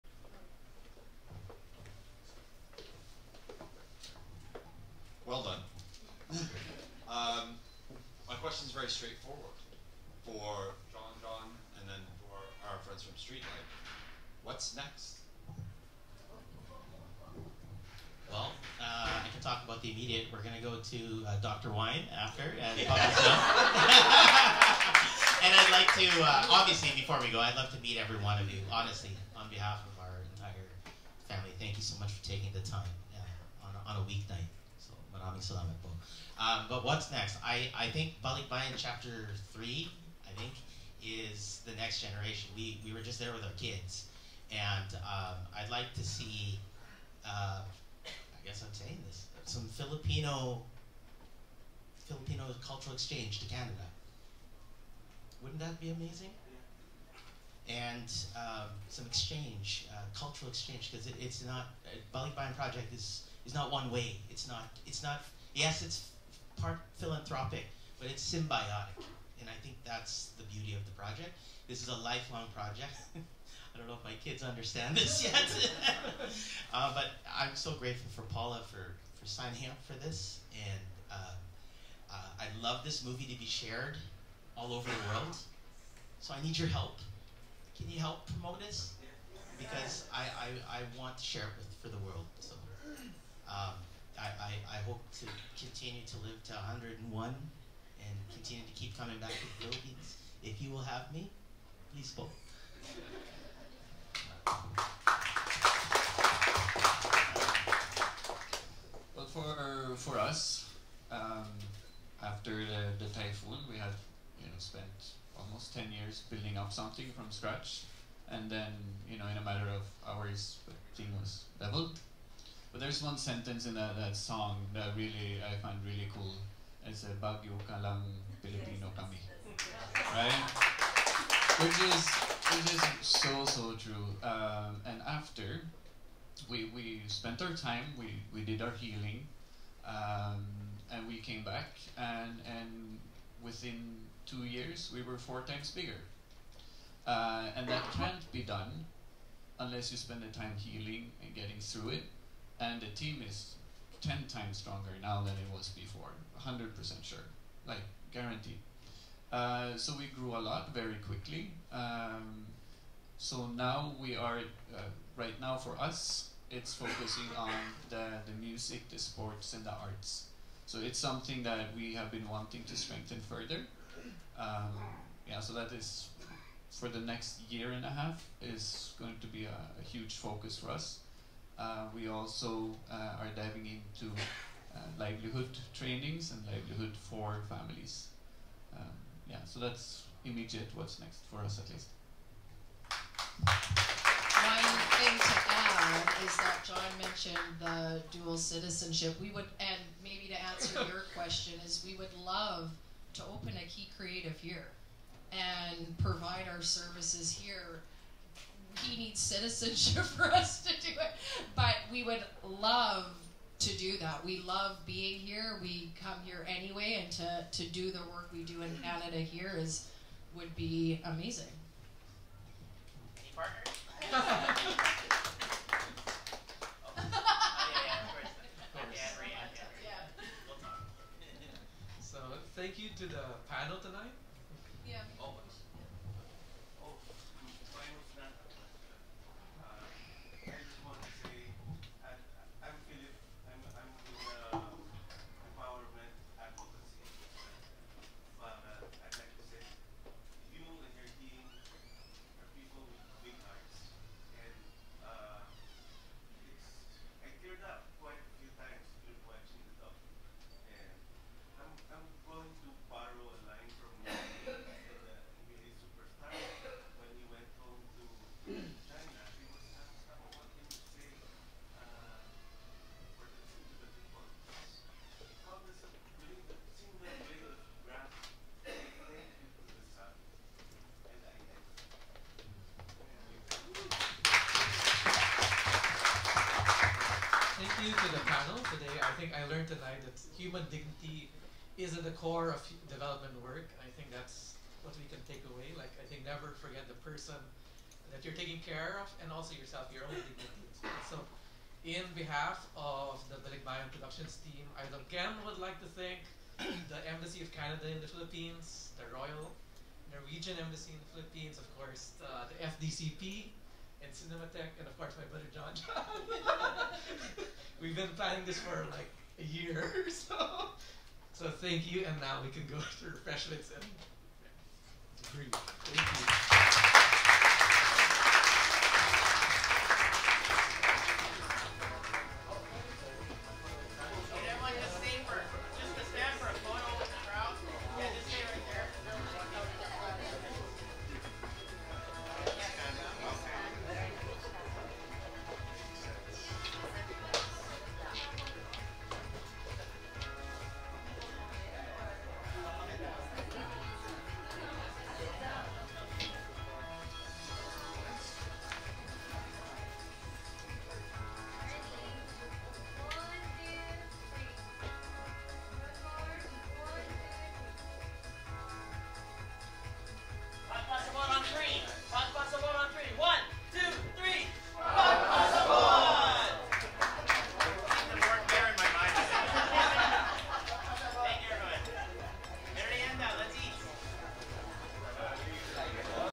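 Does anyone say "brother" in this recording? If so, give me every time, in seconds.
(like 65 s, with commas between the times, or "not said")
315 s.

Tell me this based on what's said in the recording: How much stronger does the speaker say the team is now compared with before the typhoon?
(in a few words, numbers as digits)
10 times.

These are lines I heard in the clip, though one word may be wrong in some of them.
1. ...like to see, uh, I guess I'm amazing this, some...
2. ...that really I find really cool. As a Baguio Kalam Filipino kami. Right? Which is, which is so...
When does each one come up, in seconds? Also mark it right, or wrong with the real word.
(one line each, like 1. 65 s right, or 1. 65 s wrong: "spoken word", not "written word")
1. 45 s wrong: "saying", not "amazing"
2. 124 s right.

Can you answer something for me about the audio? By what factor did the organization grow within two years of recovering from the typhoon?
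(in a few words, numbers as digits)
4.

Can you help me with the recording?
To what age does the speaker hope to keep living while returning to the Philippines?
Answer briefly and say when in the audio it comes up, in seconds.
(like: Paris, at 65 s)
101, at 96 s.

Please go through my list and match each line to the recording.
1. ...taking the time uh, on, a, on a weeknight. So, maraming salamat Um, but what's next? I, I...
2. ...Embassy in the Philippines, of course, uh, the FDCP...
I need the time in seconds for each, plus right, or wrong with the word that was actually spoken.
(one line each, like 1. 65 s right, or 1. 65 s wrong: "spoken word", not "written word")
1. 32 s right
2. 310 s right.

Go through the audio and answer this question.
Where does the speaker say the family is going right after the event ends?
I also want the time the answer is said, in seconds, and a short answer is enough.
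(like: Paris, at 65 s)
Dr. Wine, at 21 s.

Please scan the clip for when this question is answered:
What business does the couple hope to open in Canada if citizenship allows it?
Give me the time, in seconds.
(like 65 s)
203 s.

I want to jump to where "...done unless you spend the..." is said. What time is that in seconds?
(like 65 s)
148 s.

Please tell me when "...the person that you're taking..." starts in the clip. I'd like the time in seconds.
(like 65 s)
296 s.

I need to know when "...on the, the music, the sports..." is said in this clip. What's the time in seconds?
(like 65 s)
167 s.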